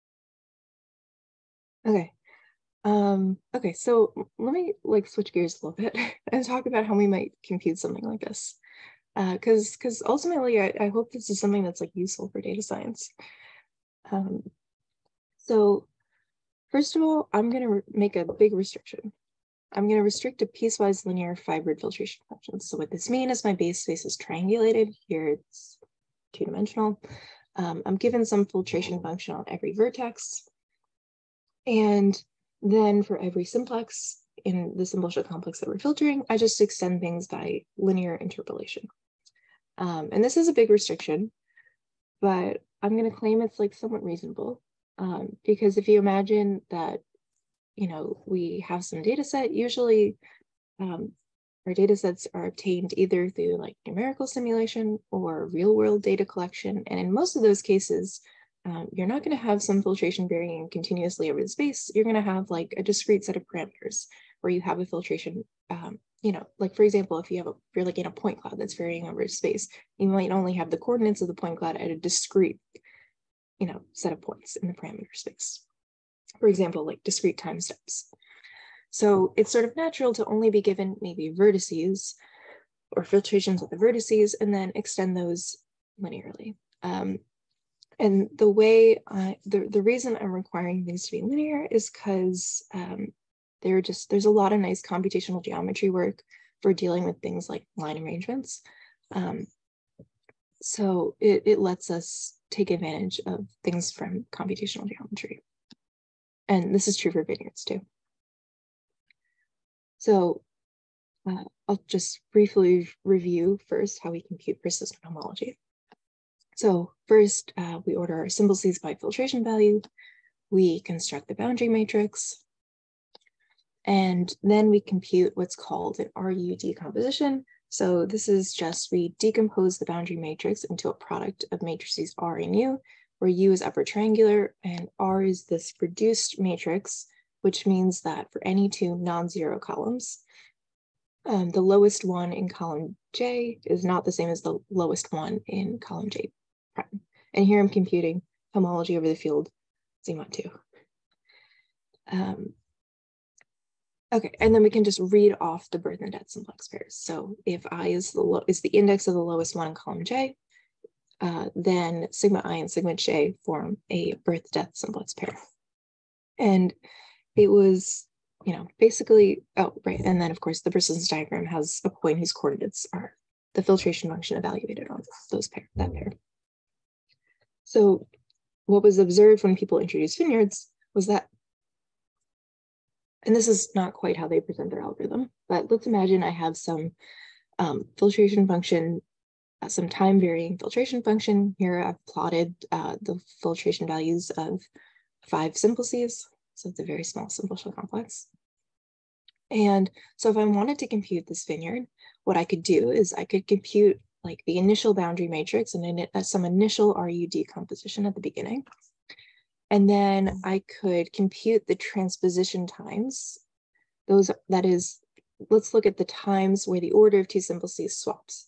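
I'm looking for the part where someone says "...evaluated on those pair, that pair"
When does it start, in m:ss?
2:54.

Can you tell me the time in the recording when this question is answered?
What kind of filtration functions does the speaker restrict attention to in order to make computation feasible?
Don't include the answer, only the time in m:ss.
0:20.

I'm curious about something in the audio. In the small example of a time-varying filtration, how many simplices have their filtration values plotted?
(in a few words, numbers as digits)
5.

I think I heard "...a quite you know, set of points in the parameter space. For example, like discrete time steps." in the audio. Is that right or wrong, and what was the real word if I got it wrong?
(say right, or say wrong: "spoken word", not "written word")
wrong: "discrete", not "quite".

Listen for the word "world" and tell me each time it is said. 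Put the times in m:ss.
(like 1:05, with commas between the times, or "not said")
0:55.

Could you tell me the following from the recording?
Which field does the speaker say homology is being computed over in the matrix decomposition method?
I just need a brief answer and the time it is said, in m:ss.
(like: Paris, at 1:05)
Z mod 2, at 2:30.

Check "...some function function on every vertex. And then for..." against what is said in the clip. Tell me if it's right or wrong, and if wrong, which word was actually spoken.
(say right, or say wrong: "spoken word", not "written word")
wrong: "filtration", not "function".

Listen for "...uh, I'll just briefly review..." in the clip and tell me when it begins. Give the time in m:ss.
1:51.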